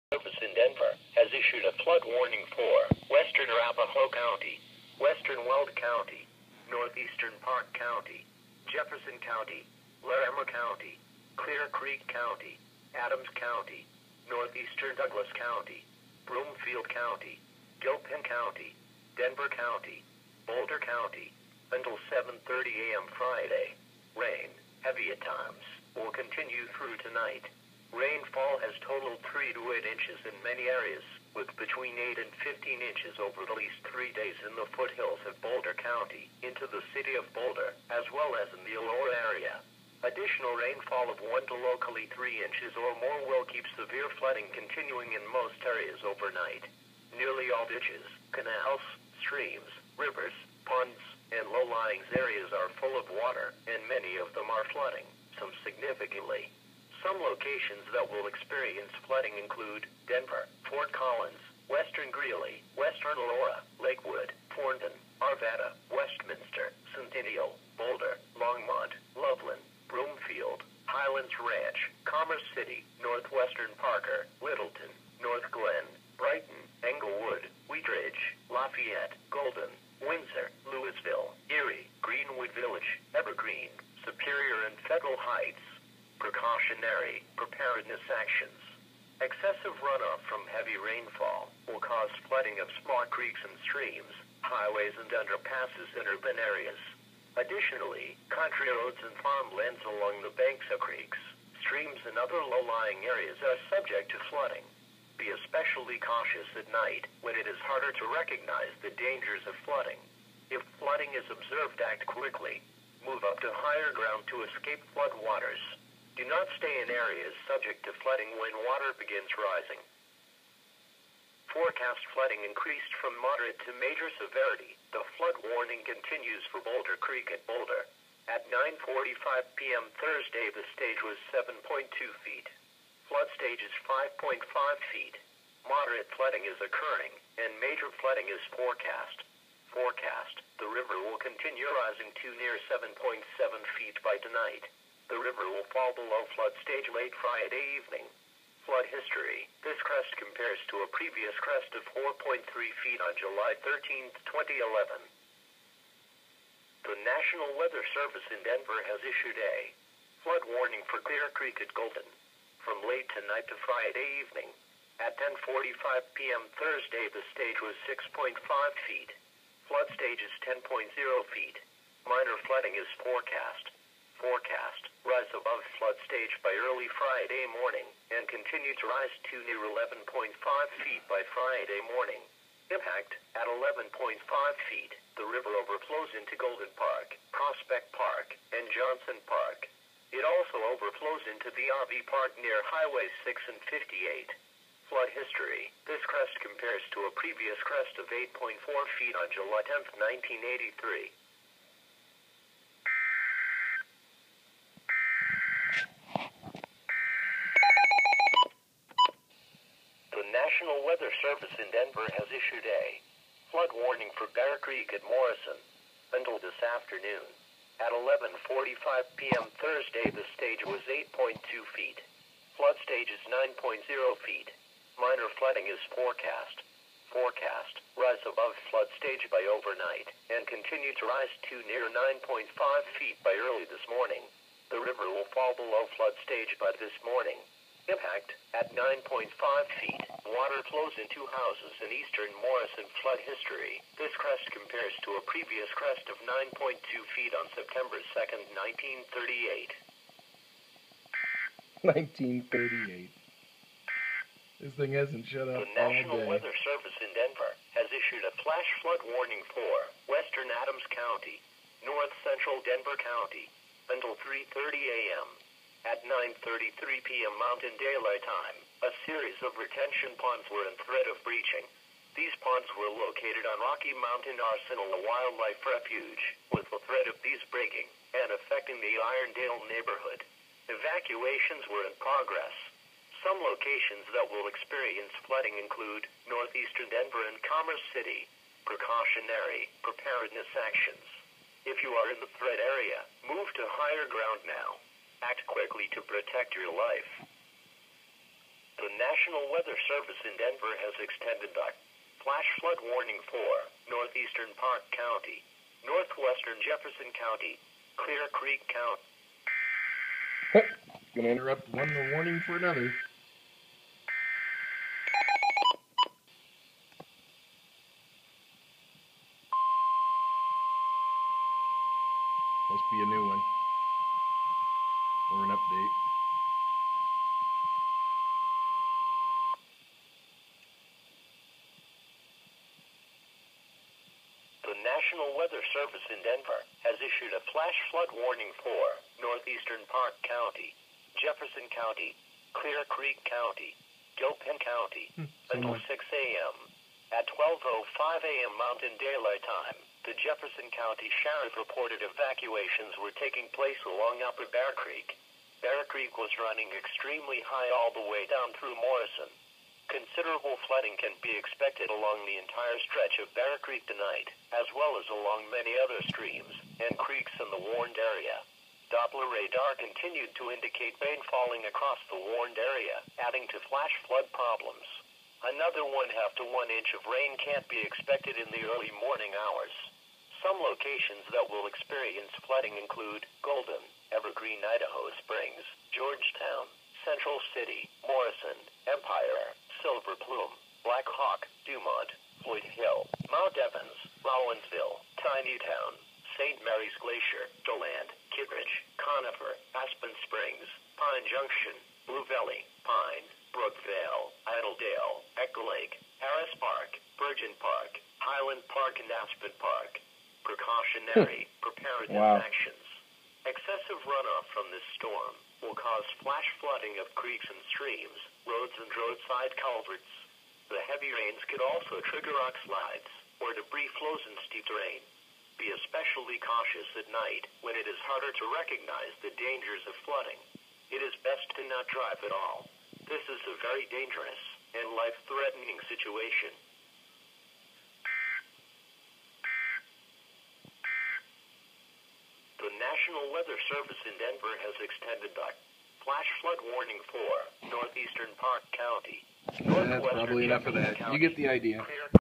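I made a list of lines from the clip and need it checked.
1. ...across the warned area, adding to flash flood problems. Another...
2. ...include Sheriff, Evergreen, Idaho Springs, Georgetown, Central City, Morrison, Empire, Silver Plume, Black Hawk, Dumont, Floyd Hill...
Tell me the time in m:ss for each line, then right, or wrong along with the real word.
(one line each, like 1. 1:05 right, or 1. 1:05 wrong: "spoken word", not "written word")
1. 6:11 right
2. 6:22 wrong: "Golden", not "Sheriff".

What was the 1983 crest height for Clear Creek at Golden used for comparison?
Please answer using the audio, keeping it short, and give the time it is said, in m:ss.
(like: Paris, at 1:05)
8.4 feet, at 3:18.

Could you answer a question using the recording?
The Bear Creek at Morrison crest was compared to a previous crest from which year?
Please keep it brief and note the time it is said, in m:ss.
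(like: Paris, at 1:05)
1938, at 4:07.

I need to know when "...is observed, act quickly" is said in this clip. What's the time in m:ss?
1:51.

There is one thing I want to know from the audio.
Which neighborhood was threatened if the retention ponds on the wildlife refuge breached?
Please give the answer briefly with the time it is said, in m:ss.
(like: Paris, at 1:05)
Irondale, at 4:38.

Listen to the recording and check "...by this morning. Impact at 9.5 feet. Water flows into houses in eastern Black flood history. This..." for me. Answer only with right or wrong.
wrong.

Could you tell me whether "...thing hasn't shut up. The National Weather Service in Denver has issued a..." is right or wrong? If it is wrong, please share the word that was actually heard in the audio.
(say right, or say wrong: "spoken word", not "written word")
right.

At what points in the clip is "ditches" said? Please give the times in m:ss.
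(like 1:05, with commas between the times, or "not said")
0:47.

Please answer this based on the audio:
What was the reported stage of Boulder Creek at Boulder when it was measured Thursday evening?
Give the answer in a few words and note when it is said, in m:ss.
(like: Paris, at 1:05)
7.2 feet, at 2:11.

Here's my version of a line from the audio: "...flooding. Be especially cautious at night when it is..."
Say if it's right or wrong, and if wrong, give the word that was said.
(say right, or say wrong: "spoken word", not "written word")
right.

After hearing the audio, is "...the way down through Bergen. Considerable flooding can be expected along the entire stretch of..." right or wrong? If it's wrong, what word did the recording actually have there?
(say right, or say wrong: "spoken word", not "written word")
wrong: "Morrison", not "Bergen".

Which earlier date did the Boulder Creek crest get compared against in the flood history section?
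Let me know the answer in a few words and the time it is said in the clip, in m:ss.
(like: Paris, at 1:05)
July 13, 2011, at 2:33.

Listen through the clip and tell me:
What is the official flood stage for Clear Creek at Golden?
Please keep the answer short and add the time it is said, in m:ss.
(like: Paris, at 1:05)
10.0 feet, at 2:50.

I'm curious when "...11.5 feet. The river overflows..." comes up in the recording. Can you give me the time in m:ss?
3:03.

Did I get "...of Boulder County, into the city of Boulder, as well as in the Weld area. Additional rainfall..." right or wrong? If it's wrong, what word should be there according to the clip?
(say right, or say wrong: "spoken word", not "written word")
wrong: "Eldora", not "Weld".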